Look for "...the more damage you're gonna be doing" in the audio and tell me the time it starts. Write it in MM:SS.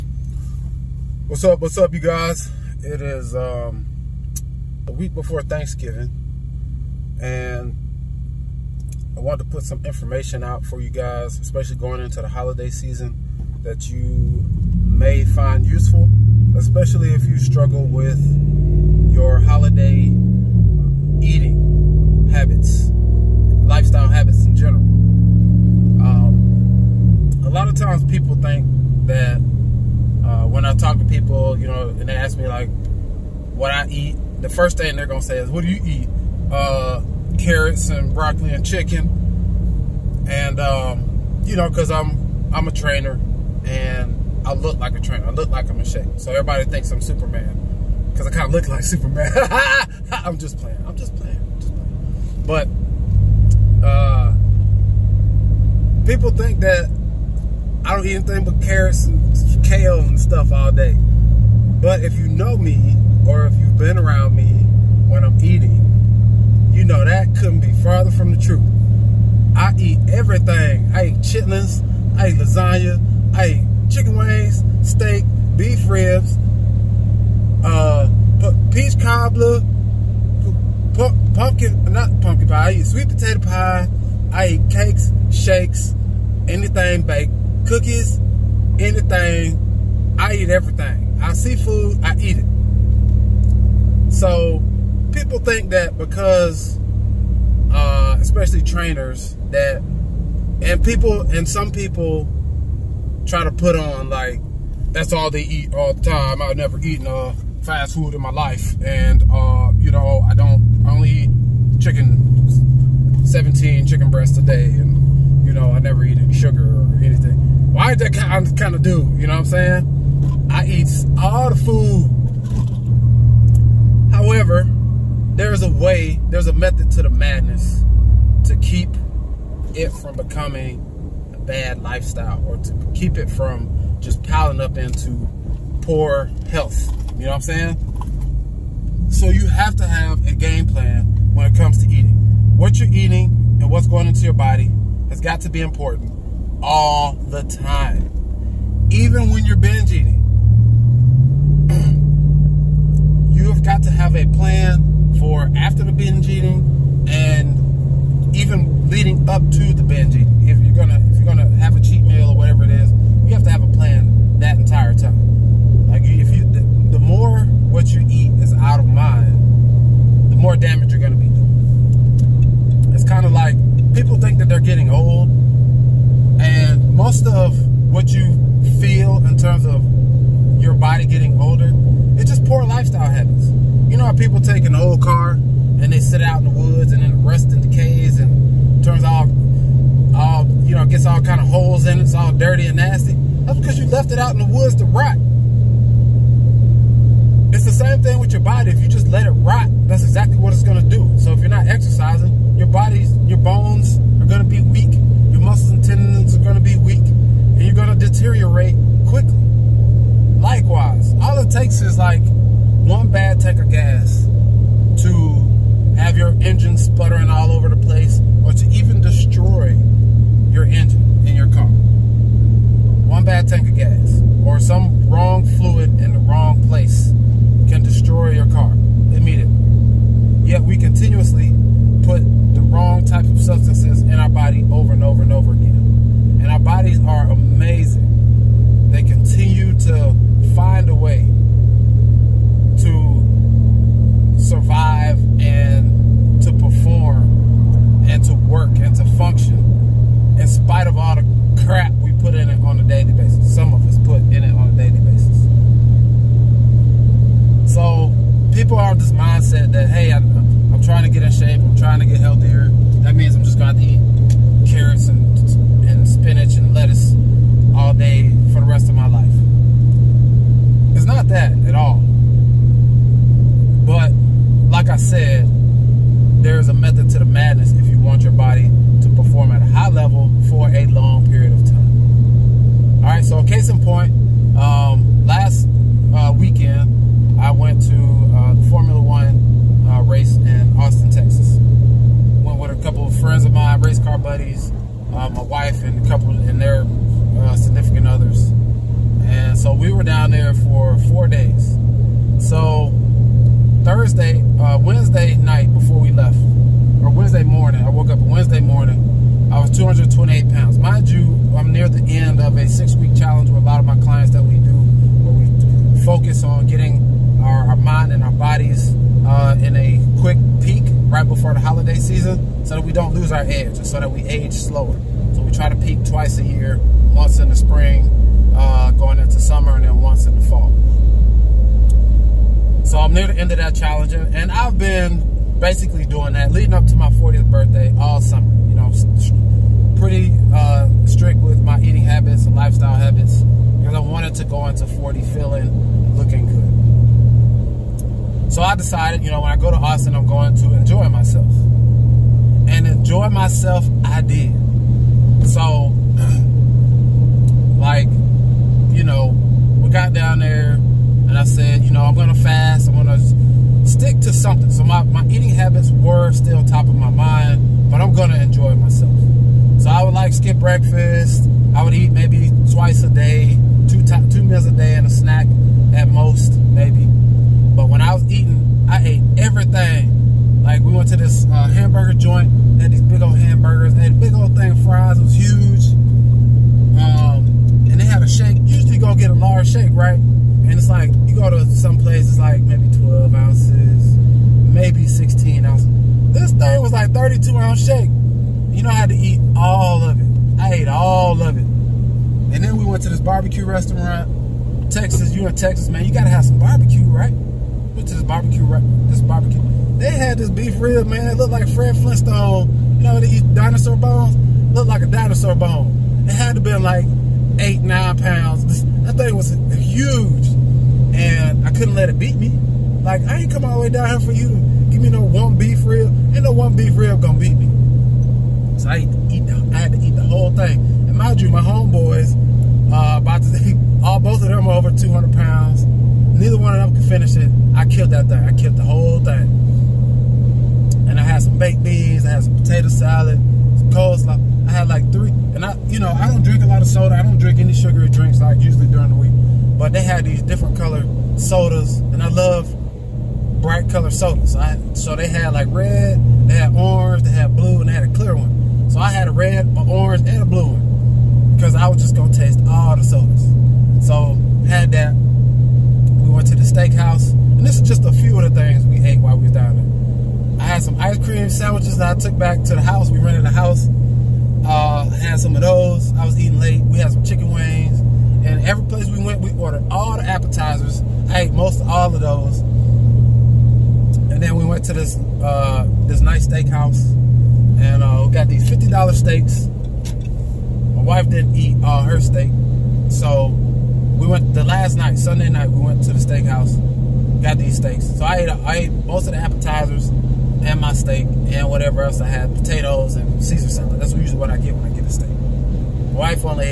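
02:50.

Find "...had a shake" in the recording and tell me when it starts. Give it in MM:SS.
06:28.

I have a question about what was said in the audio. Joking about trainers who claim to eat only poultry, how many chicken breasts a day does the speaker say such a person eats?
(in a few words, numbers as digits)
17.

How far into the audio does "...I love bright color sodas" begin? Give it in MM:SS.
07:32.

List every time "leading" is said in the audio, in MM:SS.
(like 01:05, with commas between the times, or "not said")
02:38, 05:36.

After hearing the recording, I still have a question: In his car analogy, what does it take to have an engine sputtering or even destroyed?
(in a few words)
one bad tank of gas.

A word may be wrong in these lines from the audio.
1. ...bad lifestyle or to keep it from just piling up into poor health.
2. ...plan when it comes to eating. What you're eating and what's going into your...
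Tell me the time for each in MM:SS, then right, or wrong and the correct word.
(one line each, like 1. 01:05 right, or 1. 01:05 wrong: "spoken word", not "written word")
1. 02:11 right
2. 02:20 right.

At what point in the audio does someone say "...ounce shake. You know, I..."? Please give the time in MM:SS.
06:37.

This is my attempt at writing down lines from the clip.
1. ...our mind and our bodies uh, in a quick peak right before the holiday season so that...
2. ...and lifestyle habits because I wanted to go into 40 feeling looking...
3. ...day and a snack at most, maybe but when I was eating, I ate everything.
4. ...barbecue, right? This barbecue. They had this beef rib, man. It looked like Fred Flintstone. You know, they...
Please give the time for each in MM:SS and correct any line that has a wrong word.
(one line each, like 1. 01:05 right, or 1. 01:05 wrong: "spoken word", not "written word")
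1. 05:17 right
2. 05:42 right
3. 06:14 right
4. 06:48 right.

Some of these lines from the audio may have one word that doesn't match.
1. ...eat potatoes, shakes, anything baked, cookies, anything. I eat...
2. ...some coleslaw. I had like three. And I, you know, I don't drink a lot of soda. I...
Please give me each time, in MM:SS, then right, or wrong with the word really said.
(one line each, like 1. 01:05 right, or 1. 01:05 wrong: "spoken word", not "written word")
1. 01:24 wrong: "cakes", not "potatoes"
2. 07:23 right.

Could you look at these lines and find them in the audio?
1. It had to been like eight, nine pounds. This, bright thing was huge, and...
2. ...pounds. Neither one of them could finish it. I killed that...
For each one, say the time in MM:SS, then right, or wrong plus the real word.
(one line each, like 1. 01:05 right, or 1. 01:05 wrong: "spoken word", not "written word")
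1. 06:56 wrong: "thought", not "bright"
2. 07:15 right.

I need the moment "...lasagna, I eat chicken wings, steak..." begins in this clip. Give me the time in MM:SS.
01:12.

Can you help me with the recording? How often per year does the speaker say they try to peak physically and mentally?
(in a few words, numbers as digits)
twice a year.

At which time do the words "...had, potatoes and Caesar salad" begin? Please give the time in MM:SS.
08:22.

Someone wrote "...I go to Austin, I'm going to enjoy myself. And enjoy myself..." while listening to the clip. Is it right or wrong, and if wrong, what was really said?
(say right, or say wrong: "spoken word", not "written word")
right.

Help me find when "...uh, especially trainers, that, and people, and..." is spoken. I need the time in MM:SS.
01:37.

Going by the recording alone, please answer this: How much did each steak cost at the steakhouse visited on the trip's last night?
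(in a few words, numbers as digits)
$50.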